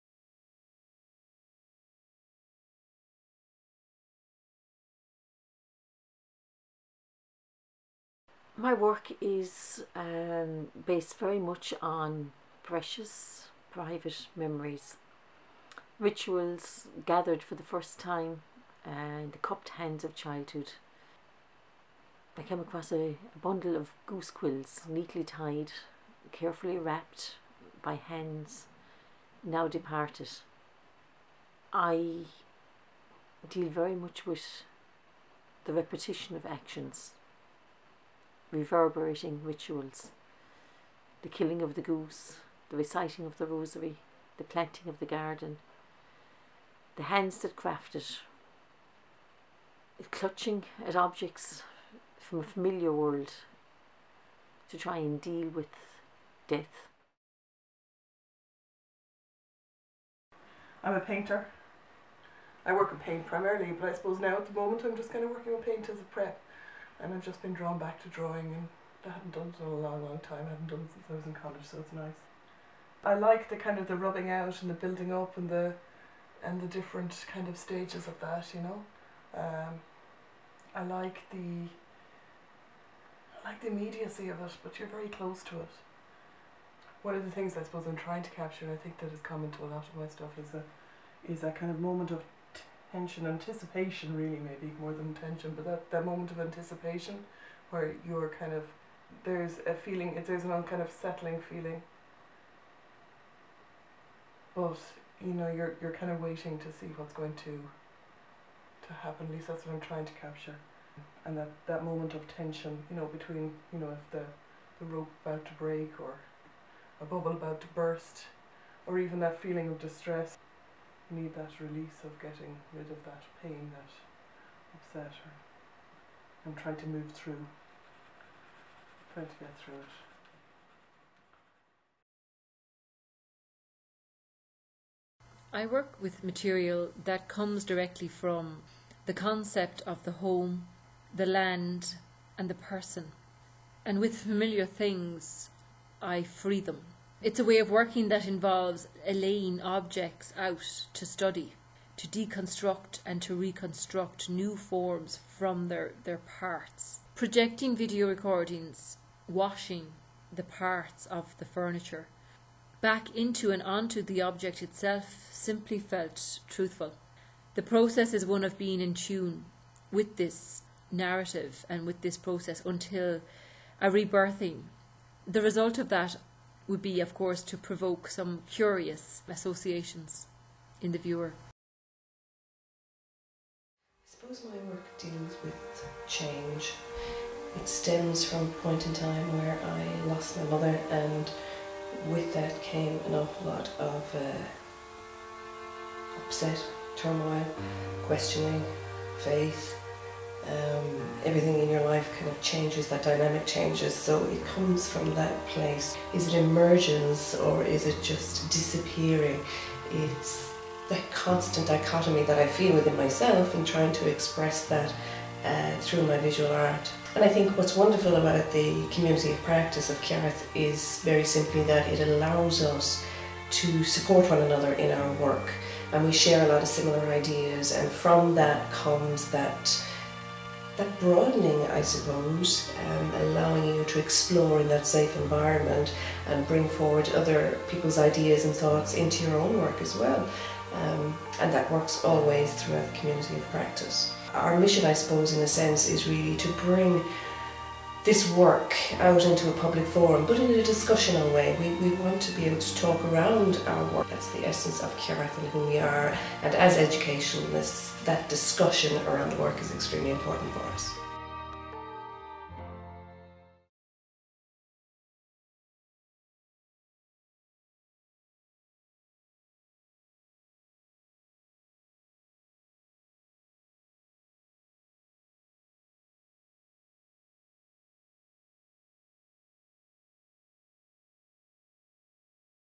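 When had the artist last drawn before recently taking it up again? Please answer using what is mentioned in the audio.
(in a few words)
college.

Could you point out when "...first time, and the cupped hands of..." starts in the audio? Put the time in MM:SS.
00:17.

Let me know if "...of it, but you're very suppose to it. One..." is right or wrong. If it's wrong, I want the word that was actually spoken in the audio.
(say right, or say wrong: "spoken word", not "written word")
wrong: "close", not "suppose".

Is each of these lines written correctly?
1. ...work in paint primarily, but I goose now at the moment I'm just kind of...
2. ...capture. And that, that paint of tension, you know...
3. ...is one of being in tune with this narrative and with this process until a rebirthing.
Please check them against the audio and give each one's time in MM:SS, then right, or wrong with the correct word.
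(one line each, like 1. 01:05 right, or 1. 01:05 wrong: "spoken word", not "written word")
1. 01:02 wrong: "suppose", not "goose"
2. 01:50 wrong: "moment", not "paint"
3. 02:48 right.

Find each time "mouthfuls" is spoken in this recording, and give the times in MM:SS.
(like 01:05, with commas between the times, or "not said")
not said.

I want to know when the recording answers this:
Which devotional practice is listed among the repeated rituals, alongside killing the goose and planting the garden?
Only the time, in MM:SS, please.
00:42.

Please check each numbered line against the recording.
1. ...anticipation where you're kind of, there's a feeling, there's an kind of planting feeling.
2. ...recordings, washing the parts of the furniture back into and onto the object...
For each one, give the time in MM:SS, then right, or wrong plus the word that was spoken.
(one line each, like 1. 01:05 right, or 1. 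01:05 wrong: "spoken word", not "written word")
1. 01:36 wrong: "settling", not "planting"
2. 02:38 right.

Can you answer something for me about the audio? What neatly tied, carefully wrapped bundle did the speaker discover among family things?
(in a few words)
goose quills.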